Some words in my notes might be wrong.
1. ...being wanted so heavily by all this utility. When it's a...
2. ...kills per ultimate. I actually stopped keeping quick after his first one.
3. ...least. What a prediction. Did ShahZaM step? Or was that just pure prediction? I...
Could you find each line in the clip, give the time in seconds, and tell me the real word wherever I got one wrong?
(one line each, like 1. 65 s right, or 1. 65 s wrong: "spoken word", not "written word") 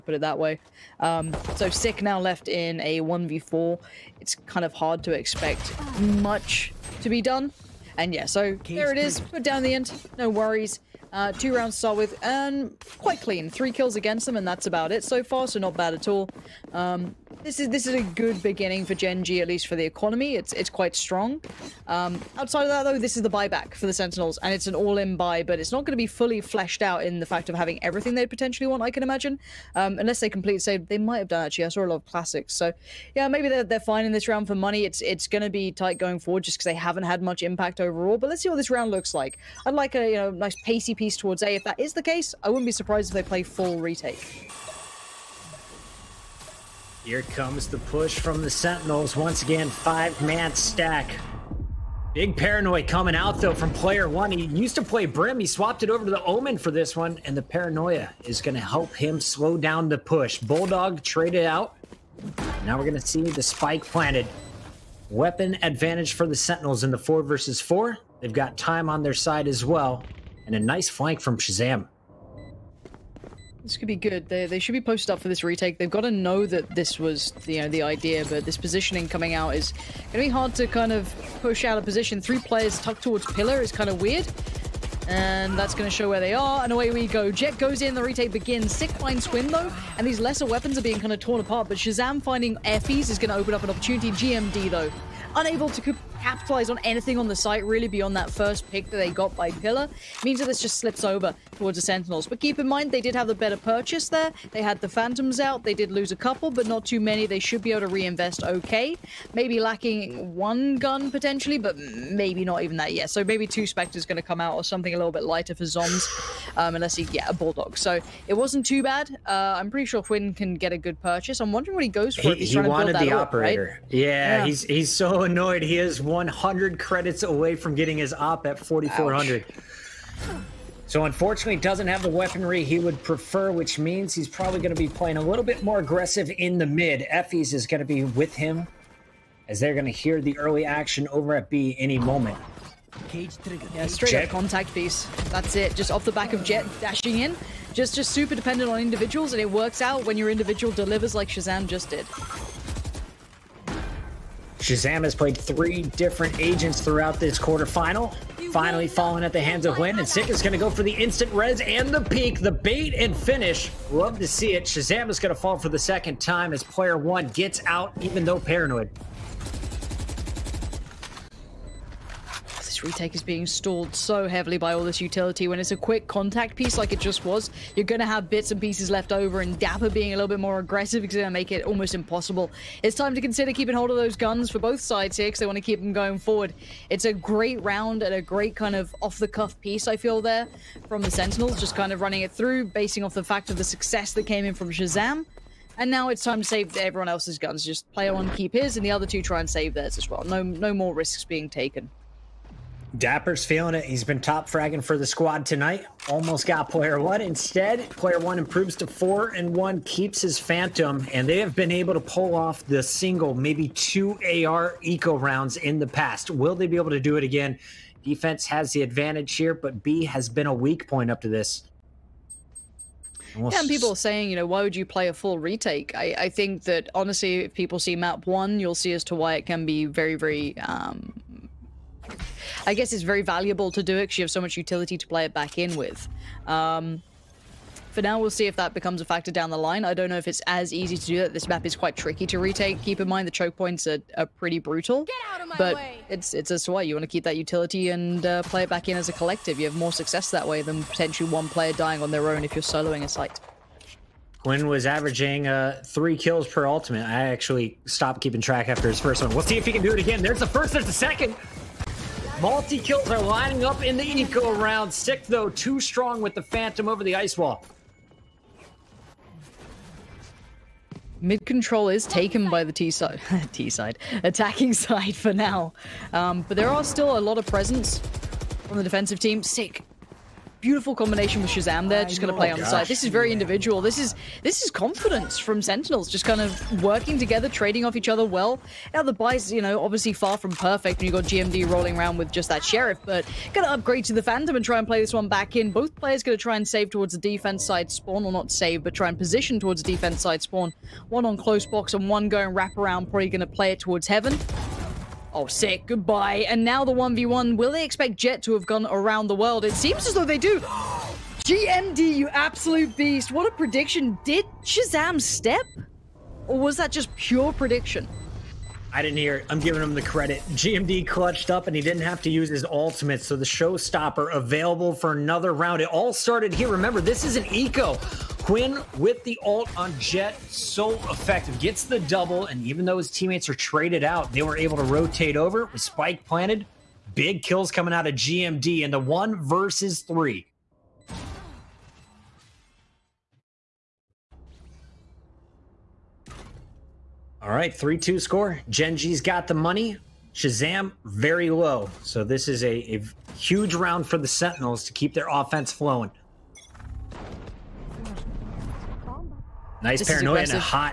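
1. 173 s wrong: "stalled", not "wanted"
2. 256 s wrong: "track", not "quick"
3. 312 s wrong: "beast", not "least".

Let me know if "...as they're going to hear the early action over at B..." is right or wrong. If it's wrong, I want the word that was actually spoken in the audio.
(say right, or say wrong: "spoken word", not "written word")
right.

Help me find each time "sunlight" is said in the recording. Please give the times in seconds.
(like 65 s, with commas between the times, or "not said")
not said.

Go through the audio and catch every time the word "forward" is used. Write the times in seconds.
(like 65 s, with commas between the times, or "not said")
36 s, 186 s.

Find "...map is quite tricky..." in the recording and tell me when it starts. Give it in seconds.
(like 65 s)
241 s.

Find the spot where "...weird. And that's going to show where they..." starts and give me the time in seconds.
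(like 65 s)
84 s.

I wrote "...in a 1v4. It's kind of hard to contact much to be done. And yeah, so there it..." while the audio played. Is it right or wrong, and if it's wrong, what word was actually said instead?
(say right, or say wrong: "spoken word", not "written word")
wrong: "expect", not "contact".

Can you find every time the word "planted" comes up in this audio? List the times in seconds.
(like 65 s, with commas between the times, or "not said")
63 s, 336 s.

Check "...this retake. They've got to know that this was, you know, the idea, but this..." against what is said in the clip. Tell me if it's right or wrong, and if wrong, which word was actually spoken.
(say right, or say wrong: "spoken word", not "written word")
right.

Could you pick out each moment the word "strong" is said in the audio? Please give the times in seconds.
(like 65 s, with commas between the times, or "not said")
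20 s, 265 s.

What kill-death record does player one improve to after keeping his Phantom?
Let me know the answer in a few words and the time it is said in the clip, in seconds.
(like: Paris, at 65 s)
4 and 1, at 208 s.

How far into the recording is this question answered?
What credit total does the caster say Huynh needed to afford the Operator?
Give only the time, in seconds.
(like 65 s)
128 s.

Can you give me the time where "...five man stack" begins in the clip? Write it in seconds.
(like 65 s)
49 s.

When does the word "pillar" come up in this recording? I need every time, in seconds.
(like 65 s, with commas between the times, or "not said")
83 s, 99 s.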